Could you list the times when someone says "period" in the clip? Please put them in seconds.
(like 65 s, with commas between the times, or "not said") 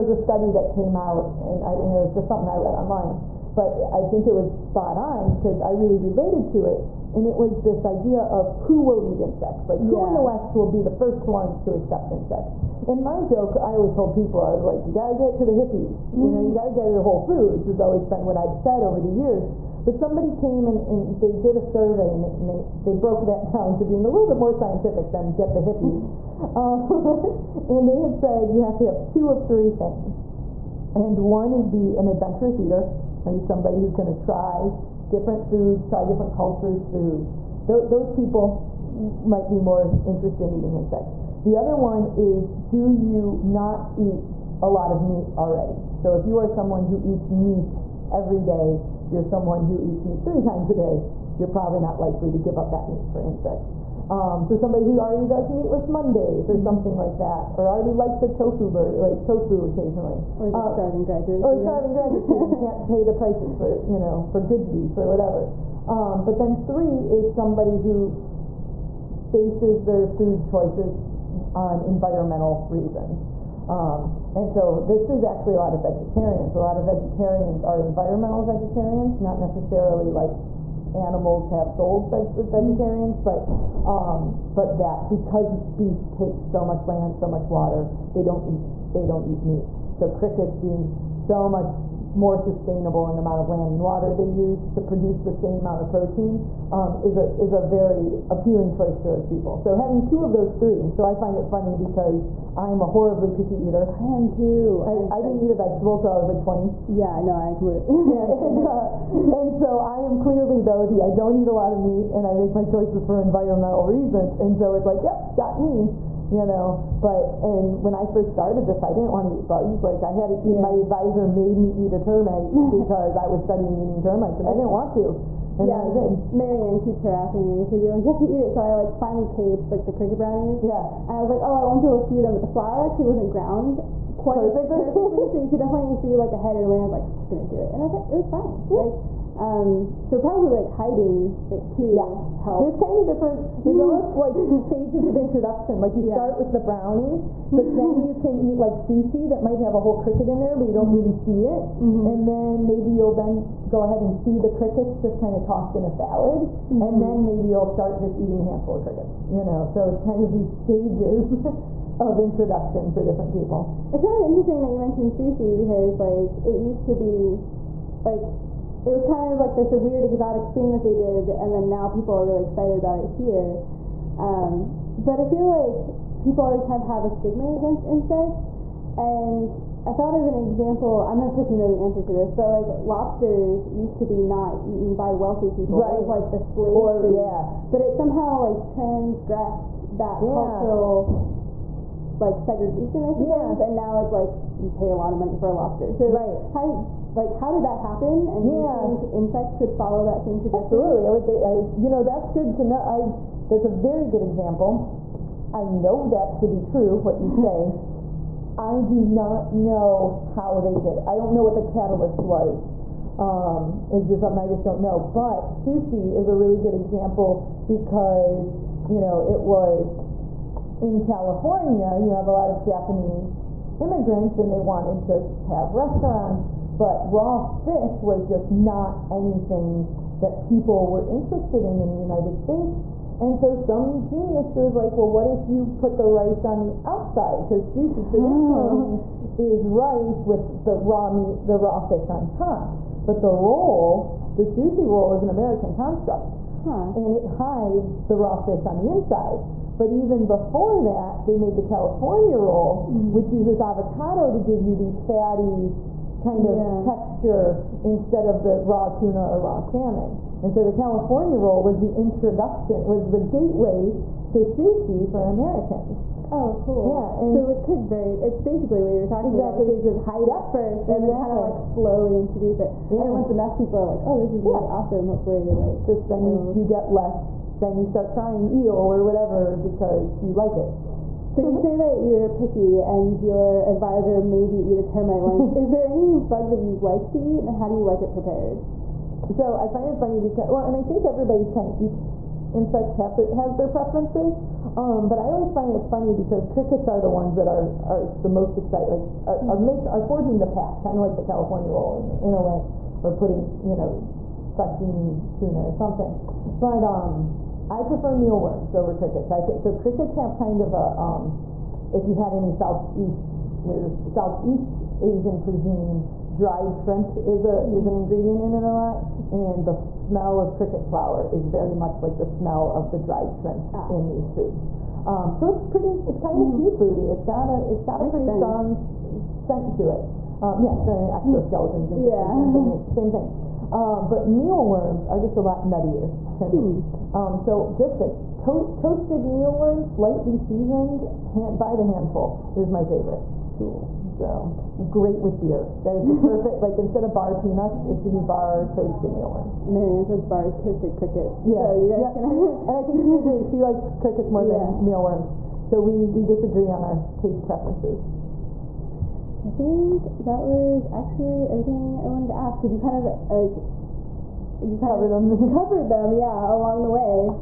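not said.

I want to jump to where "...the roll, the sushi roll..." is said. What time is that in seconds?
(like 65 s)
243 s.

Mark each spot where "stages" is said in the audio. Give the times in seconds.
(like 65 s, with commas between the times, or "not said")
144 s, 160 s, 269 s.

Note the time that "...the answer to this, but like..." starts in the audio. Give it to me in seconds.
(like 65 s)
181 s.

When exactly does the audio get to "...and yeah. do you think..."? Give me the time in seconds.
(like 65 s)
198 s.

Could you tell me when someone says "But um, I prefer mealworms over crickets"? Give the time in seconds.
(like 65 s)
306 s.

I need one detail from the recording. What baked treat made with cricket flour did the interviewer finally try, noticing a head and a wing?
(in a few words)
brownies.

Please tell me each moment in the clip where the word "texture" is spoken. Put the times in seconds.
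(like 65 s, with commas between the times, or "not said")
256 s.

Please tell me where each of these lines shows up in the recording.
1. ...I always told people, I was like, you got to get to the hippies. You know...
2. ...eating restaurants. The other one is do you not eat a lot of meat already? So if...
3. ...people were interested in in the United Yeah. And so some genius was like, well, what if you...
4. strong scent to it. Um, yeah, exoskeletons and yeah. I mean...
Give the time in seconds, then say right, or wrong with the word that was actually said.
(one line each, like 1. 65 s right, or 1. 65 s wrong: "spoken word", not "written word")
1. 13 s right
2. 40 s wrong: "insects", not "restaurants"
3. 230 s wrong: "States", not "Yeah"
4. 328 s right.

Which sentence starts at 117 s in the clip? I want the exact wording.
But and when I first started this, I didn't want to eat bugs.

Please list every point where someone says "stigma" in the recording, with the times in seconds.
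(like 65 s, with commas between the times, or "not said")
177 s.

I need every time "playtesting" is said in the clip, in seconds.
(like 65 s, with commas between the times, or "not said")
not said.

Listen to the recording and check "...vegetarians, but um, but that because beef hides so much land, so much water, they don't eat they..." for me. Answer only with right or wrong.
wrong.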